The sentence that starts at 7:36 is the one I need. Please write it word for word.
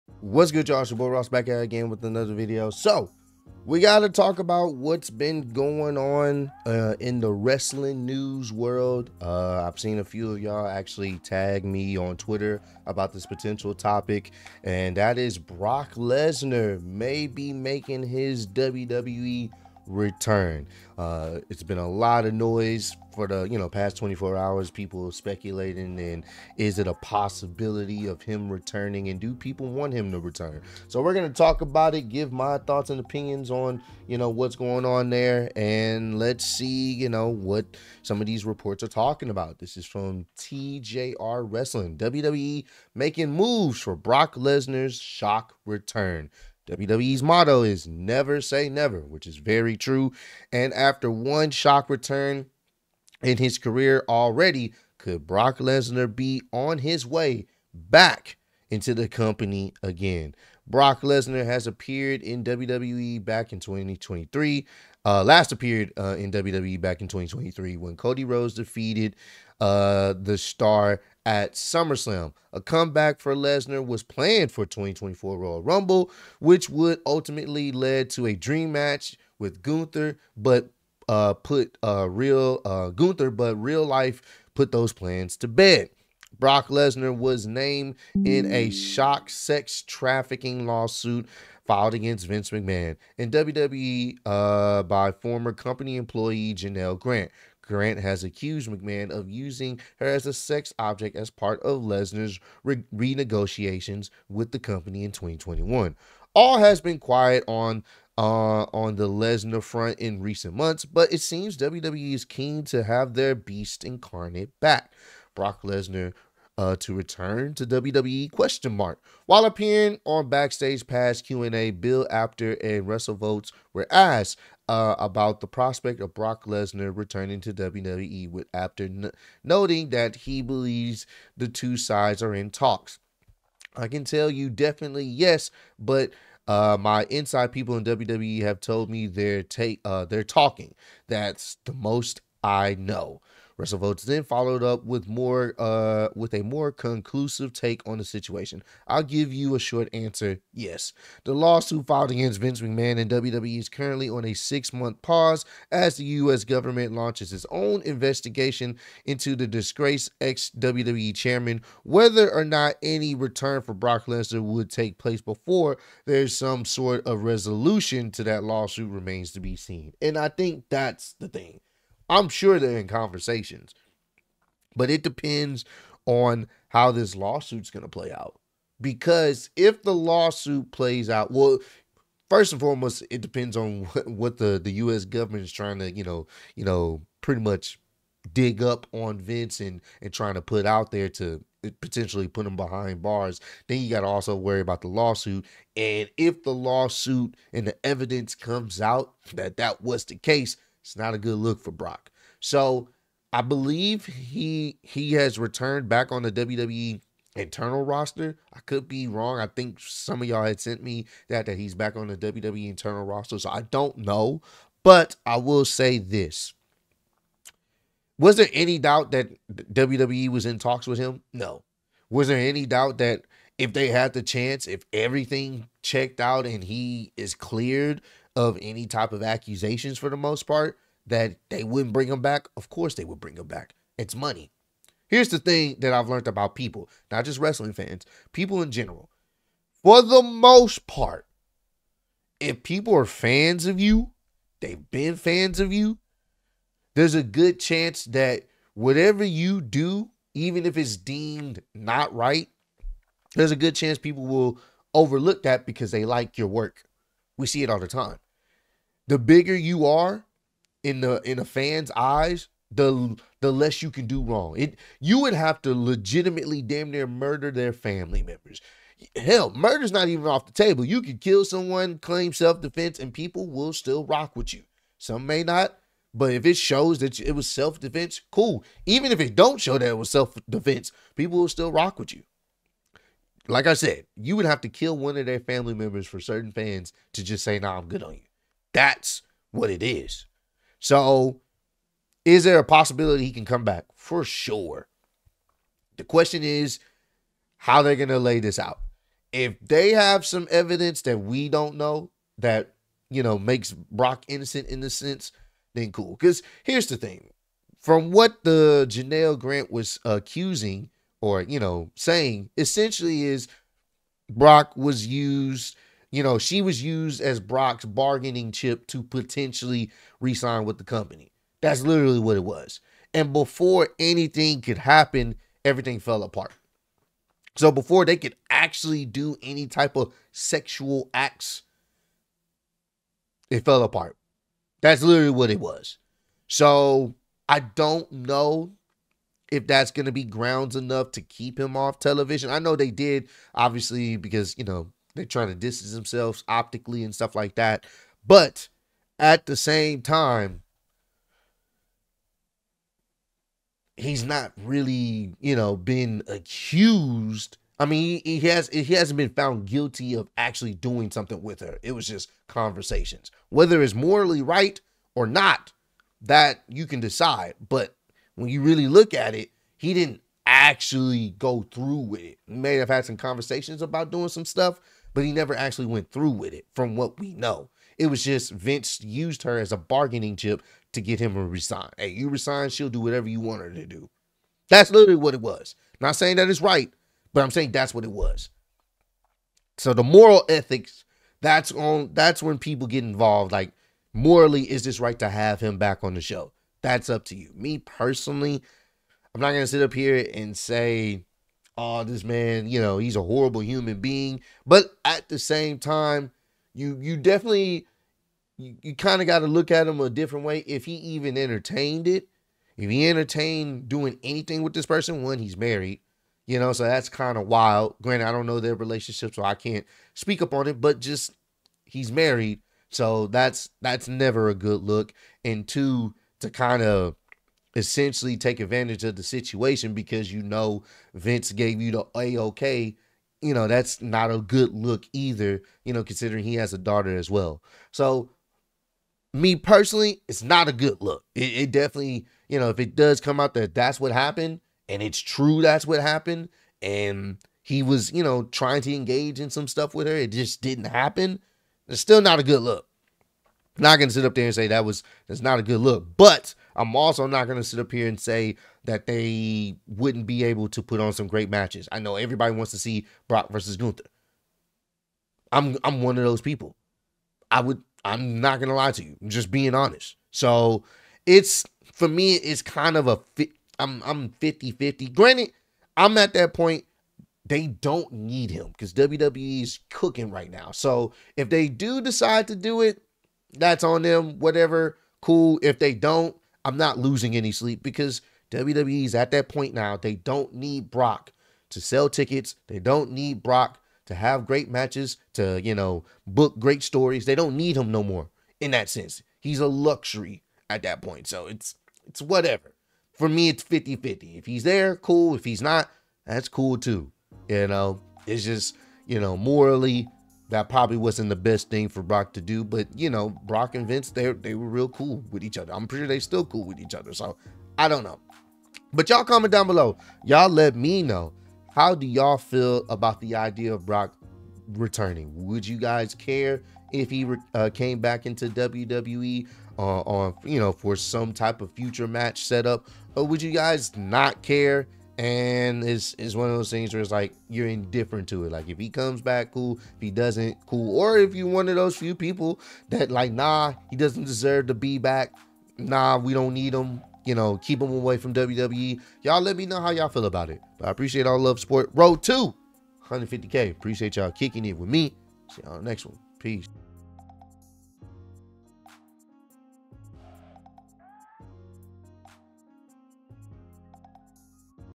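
But I'm also not going to sit up here and say that they wouldn't be able to put on some great matches.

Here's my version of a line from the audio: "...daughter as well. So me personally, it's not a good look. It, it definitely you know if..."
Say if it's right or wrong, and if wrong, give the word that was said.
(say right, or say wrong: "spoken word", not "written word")
right.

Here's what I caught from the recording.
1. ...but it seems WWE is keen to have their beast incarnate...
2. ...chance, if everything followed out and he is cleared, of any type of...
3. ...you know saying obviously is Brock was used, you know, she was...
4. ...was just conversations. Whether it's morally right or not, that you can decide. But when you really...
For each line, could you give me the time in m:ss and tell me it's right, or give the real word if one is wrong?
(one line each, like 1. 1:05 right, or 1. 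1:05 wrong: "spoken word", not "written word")
1. 1:50 right
2. 3:44 wrong: "checked", not "followed"
3. 5:11 wrong: "essentially", not "obviously"
4. 6:01 right.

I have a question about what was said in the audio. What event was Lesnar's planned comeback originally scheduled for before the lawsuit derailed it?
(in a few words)
2024 Royal Rumble.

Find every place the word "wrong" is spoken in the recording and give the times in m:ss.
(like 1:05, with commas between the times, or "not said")
3:29, 4:24.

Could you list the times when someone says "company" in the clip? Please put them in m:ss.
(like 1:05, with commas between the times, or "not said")
0:59, 1:35, 1:44, 5:20.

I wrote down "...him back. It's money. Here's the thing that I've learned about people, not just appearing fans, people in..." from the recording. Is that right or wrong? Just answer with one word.
wrong.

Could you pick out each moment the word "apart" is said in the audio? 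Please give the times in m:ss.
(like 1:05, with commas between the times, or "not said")
5:26, 5:33.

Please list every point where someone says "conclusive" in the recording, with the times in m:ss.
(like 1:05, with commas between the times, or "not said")
2:26.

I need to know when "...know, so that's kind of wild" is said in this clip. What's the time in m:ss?
6:56.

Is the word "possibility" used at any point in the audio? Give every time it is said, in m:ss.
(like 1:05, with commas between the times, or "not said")
0:26, 4:52.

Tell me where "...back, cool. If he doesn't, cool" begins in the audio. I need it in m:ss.
8:59.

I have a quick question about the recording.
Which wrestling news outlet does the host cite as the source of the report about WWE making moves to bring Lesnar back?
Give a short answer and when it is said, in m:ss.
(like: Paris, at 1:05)
TJR Wrestling, at 0:40.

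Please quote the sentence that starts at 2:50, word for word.
And I think that's the thing.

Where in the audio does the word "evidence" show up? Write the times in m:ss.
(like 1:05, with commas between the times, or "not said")
3:17, 5:00.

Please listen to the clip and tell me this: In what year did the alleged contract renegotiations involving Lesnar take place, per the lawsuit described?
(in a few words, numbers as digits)
2021.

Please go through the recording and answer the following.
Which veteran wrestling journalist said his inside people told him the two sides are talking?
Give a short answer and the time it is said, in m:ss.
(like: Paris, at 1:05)
Bill Apter, at 2:01.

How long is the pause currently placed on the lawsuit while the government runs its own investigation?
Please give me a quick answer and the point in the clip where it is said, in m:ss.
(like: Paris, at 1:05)
6 months, at 2:34.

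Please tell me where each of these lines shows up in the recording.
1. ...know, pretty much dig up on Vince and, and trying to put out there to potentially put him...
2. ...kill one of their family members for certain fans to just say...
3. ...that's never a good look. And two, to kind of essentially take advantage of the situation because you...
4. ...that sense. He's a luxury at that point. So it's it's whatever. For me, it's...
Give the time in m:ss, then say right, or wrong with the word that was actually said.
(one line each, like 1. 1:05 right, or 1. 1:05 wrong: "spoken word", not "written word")
1. 3:06 right
2. 4:44 right
3. 7:03 right
4. 8:18 right.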